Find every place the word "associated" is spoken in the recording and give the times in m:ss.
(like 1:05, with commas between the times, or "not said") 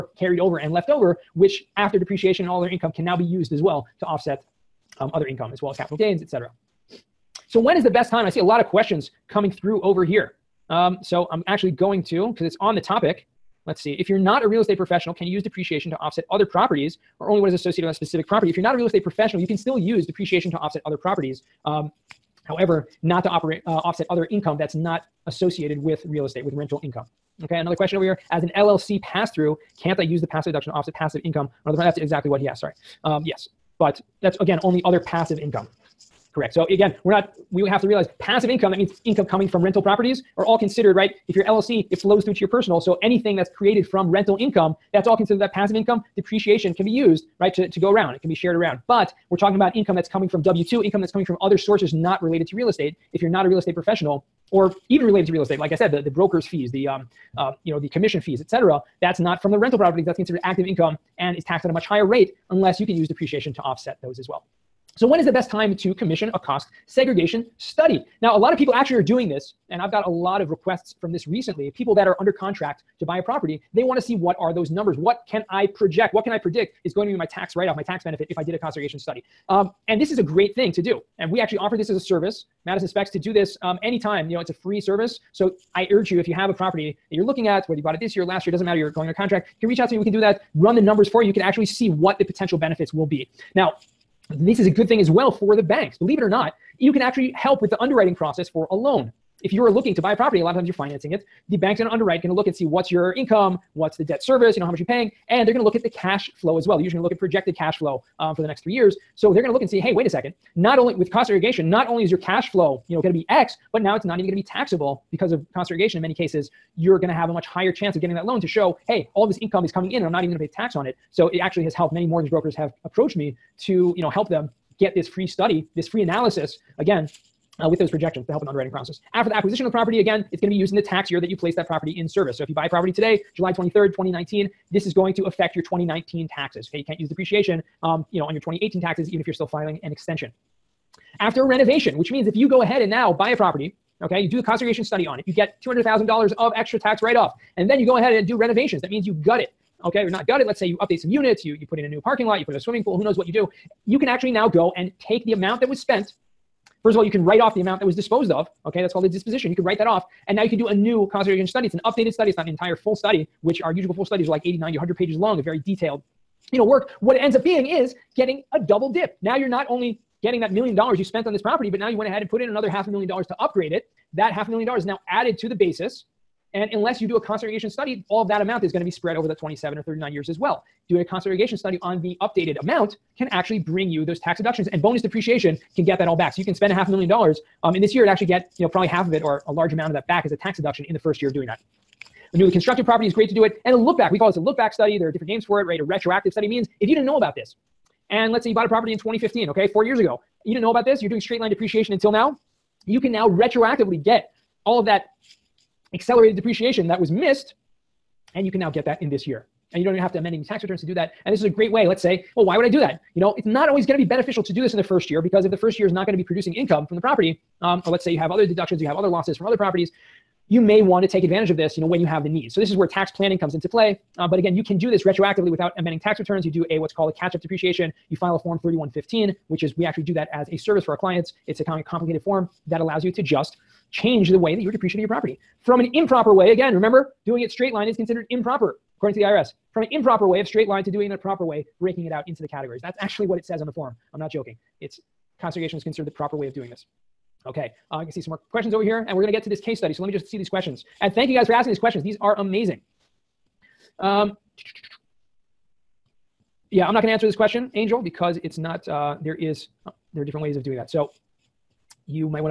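0:17, 0:25.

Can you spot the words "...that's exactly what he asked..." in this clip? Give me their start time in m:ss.
0:31.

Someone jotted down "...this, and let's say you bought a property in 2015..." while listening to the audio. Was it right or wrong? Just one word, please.
right.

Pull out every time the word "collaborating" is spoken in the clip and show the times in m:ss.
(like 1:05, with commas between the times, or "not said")
not said.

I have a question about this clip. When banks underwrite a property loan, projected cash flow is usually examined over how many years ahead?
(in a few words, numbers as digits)
3 years.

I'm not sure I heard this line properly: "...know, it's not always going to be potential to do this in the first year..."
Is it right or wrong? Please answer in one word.
wrong.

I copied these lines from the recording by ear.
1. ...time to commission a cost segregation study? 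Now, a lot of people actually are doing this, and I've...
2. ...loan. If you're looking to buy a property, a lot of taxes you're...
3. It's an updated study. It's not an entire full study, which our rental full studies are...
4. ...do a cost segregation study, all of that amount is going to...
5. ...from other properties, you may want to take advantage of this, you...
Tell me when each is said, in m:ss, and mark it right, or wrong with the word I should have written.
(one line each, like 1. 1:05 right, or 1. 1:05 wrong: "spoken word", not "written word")
1. 1:05 right
2. 1:38 wrong: "times", not "taxes"
3. 2:41 wrong: "usual", not "rental"
4. 2:57 right
5. 3:39 right.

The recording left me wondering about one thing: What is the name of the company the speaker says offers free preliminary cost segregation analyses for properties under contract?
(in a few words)
Madison Specs.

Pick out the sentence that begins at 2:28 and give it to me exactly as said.
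That means you gut it, okay, or not gut it.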